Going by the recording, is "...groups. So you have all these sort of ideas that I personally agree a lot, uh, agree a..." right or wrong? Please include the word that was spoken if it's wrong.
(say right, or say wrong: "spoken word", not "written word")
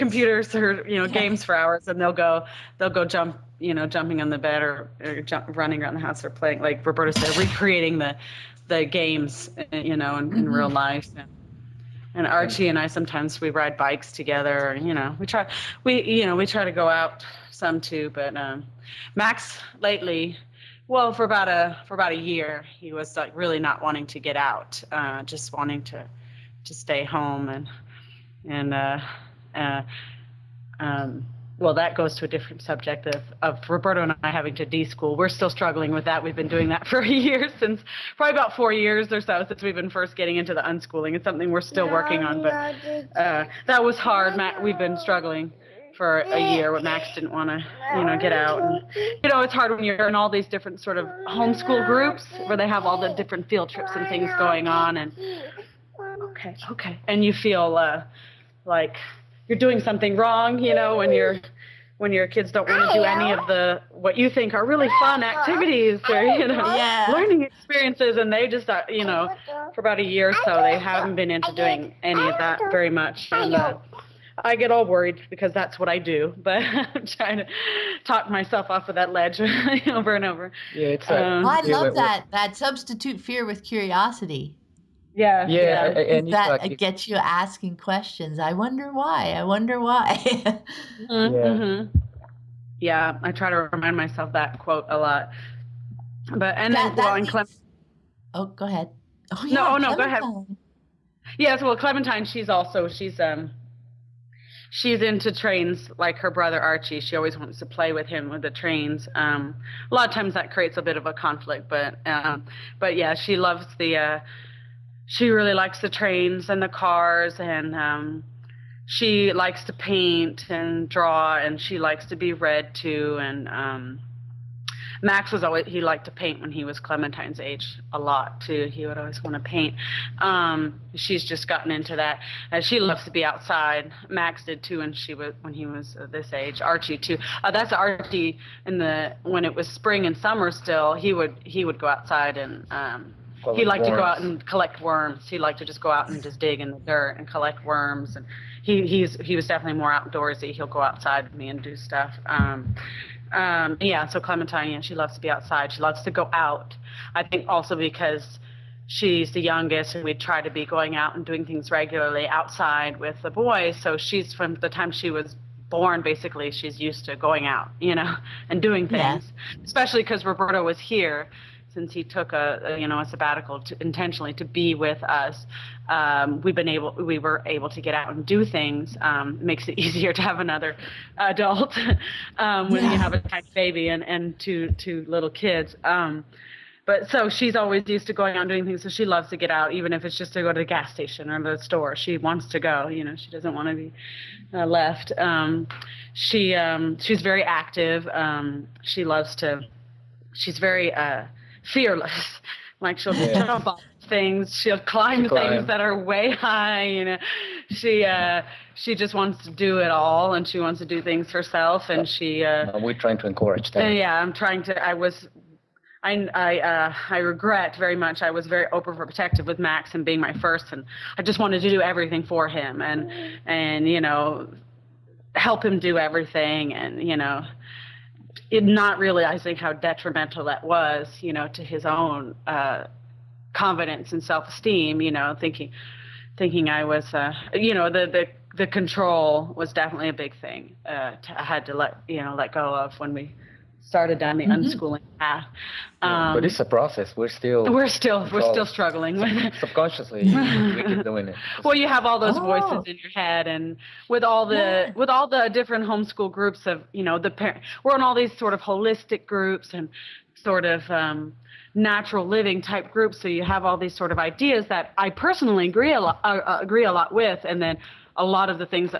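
right.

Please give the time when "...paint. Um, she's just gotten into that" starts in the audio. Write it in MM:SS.
02:09.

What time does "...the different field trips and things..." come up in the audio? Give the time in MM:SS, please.
00:53.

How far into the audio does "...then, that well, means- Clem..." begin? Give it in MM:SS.
01:36.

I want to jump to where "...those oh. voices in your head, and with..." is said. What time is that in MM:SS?
04:12.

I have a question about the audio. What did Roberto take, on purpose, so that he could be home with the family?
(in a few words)
a sabbatical.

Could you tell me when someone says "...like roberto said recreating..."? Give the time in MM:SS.
00:06.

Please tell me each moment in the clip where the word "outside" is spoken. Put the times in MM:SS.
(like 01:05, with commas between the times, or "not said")
02:13, 02:21, 02:30, 02:35, 02:42.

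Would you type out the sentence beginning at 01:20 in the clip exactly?
Yeah, it's um, well, I love that that substitute fear with curiosity.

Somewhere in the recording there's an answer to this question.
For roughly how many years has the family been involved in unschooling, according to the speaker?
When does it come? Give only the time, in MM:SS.
00:38.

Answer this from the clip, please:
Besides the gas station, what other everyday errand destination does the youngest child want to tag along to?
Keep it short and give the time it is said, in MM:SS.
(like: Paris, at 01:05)
the store, at 03:11.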